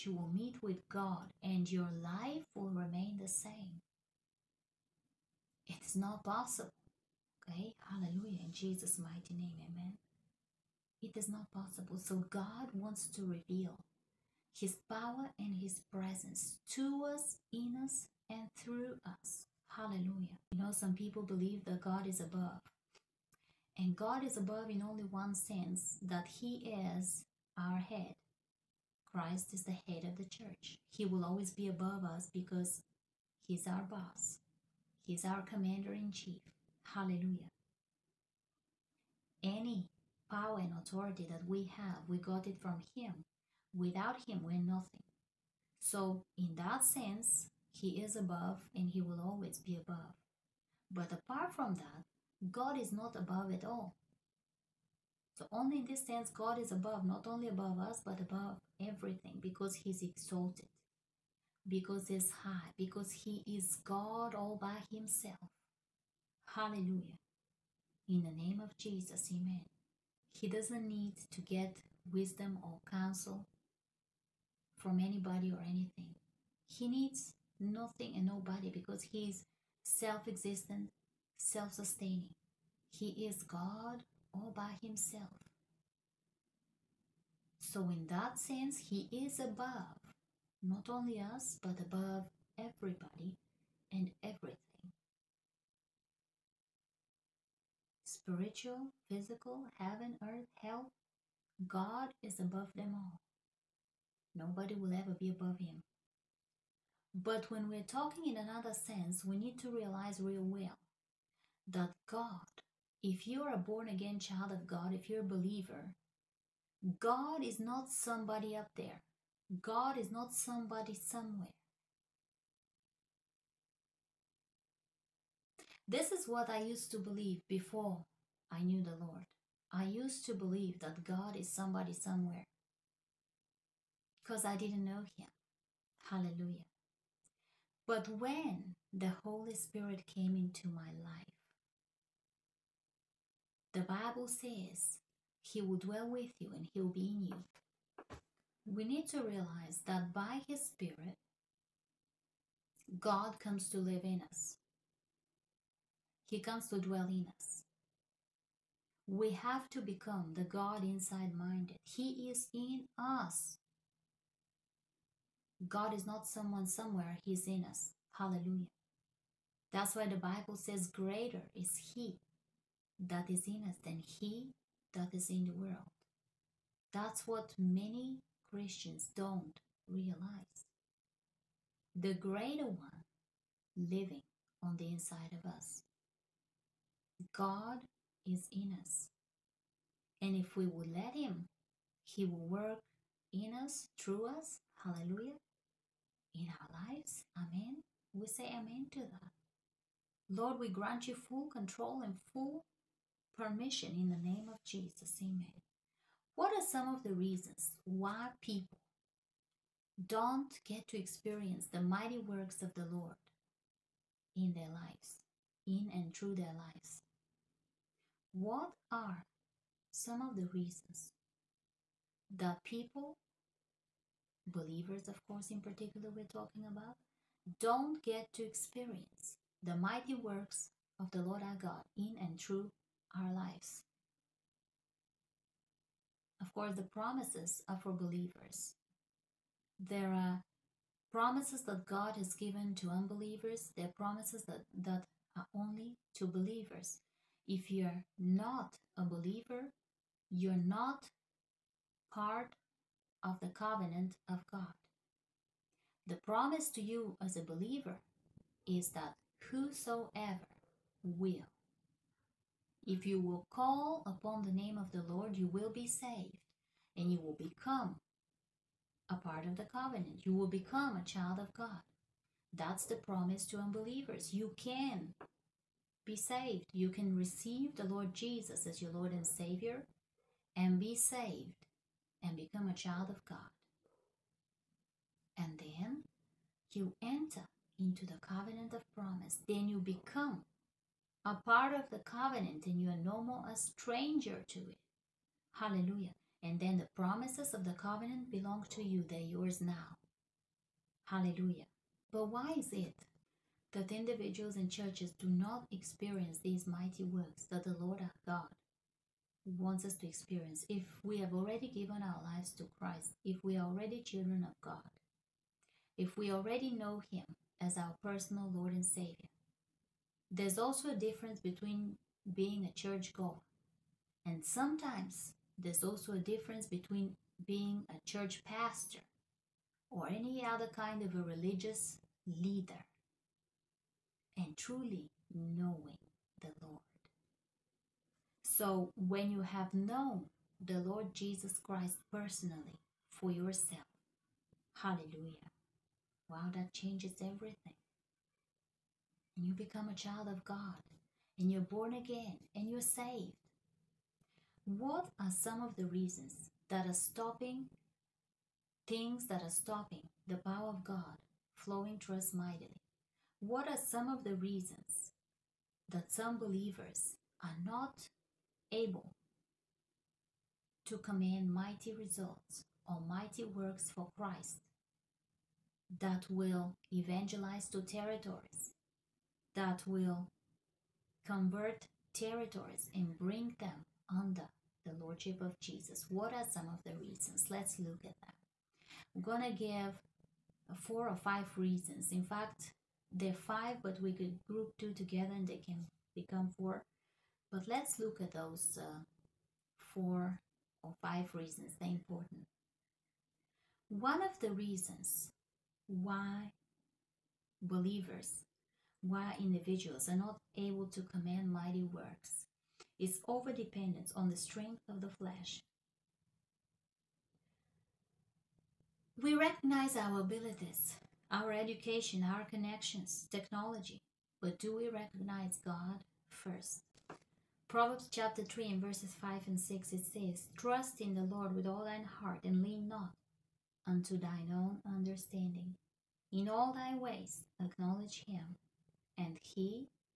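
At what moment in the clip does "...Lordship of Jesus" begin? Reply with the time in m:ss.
6:25.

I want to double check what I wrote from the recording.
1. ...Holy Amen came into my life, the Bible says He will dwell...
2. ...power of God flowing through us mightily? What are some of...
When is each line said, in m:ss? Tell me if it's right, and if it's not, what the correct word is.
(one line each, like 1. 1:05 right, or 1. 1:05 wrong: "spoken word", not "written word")
1. 2:19 wrong: "Spirit", not "Amen"
2. 6:00 right.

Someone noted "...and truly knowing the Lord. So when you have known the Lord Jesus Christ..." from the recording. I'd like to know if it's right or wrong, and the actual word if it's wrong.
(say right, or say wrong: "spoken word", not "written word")
right.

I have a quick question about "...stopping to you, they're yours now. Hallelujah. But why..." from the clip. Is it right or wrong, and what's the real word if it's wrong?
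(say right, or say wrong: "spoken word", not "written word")
wrong: "belong", not "stopping".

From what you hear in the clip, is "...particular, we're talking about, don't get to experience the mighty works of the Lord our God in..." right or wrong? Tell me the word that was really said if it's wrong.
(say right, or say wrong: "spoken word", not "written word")
right.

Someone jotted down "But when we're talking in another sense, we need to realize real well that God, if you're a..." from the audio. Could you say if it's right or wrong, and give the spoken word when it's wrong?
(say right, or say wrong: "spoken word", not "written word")
right.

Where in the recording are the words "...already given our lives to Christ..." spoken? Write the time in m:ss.
5:11.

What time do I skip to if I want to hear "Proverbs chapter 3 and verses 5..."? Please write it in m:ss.
7:07.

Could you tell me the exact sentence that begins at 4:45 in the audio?
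And then you enter into the covenant of promise.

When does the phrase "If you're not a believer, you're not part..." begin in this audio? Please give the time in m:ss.
4:07.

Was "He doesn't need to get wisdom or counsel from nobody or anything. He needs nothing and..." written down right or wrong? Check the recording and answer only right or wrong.
wrong.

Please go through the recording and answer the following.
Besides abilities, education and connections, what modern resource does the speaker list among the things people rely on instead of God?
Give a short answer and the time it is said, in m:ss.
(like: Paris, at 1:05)
Technology, at 7:03.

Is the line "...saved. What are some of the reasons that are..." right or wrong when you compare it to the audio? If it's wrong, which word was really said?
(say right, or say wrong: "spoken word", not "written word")
right.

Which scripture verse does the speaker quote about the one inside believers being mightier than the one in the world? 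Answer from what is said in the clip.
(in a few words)
Greater is He that is in us.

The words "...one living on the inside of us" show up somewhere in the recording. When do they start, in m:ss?
3:02.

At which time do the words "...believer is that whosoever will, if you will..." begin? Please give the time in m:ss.
4:17.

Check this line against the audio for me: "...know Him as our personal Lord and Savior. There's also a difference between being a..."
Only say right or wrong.
right.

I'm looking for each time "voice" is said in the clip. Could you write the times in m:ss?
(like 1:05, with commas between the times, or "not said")
not said.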